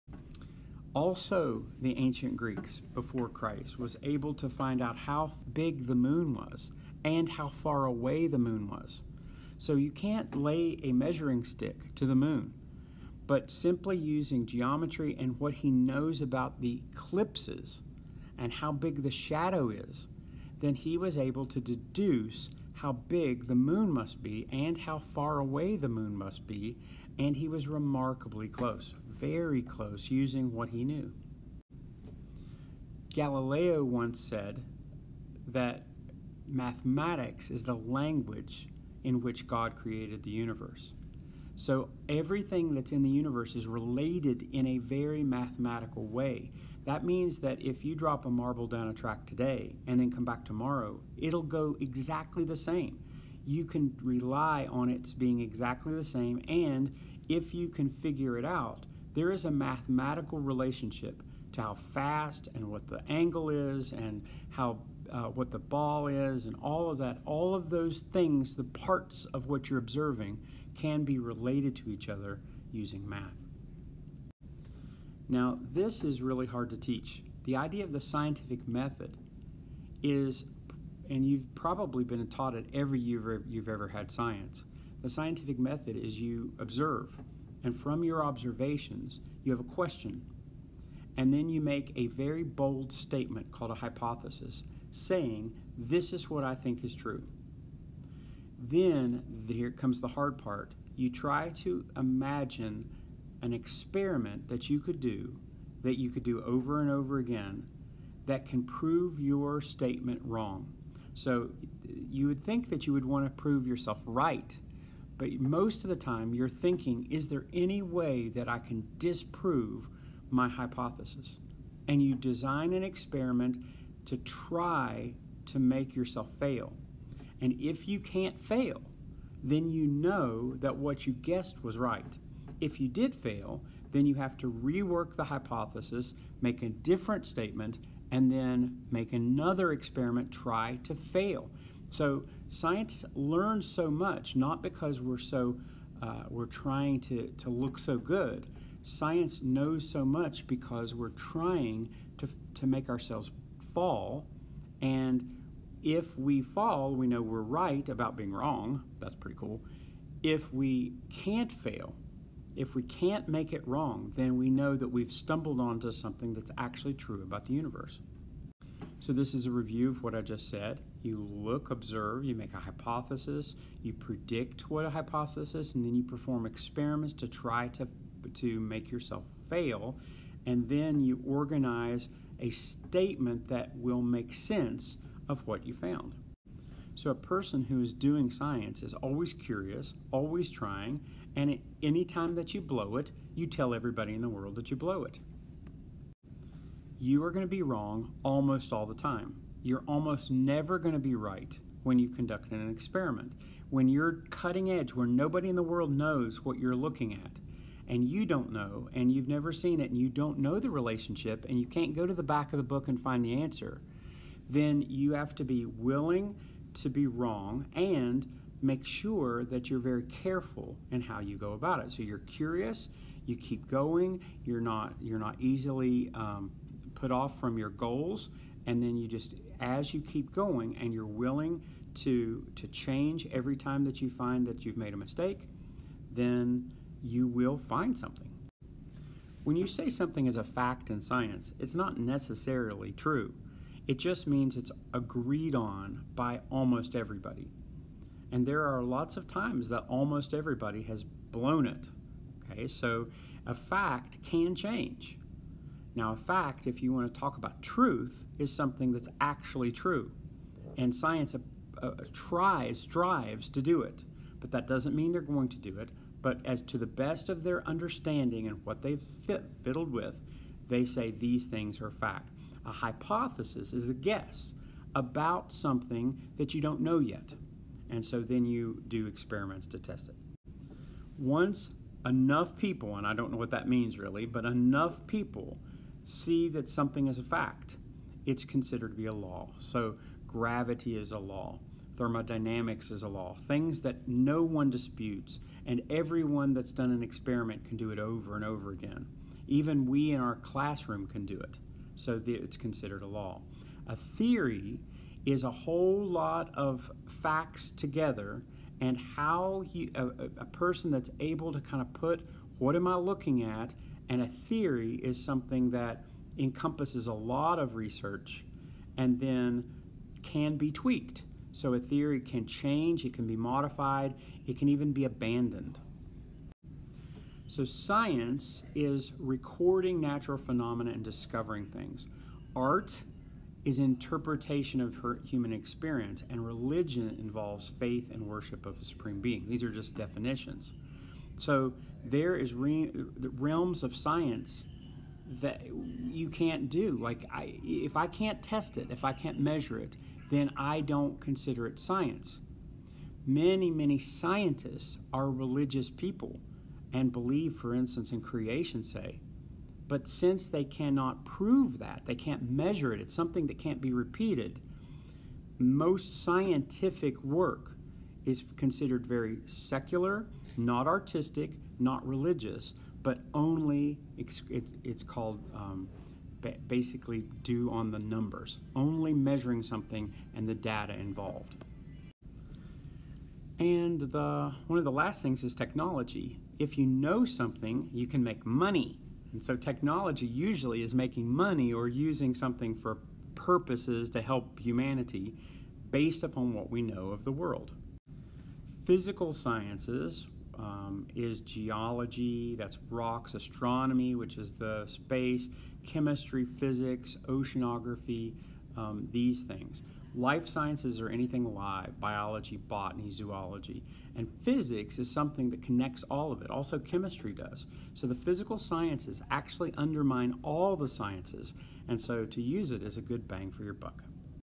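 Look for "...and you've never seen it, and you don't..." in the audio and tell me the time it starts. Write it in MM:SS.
03:28.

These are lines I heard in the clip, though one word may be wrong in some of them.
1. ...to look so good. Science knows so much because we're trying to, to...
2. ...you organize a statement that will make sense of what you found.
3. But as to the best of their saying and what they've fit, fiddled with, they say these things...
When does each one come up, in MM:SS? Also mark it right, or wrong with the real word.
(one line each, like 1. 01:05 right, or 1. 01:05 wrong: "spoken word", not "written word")
1. 02:27 right
2. 03:01 right
3. 04:26 wrong: "understanding", not "saying".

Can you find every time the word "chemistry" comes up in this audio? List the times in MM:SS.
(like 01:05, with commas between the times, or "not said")
06:45, 06:56.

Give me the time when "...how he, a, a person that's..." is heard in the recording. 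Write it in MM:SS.
05:08.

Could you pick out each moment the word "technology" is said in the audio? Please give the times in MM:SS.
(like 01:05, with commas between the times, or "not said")
06:25, 06:29.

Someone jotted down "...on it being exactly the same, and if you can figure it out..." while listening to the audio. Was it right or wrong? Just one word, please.
right.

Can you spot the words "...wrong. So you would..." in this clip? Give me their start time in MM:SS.
01:50.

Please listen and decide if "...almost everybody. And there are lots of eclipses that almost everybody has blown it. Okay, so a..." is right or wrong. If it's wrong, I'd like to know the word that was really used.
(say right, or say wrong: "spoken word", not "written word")
wrong: "times", not "eclipses".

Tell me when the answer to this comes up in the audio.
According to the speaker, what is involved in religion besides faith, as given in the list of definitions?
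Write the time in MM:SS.
05:38.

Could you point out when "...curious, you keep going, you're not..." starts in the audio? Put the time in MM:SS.
03:42.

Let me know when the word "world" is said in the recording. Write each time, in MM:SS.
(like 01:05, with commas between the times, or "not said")
03:14, 03:25, 06:37.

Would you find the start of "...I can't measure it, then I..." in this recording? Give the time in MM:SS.
05:49.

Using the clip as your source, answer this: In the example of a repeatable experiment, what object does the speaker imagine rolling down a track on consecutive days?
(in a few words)
a marble.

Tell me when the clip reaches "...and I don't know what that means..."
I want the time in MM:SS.
04:42.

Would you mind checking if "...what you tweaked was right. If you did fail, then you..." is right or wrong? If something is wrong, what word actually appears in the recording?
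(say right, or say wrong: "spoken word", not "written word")
wrong: "guessed", not "tweaked".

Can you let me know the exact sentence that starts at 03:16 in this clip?
You are going to be wrong almost all the time.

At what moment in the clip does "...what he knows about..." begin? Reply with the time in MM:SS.
00:15.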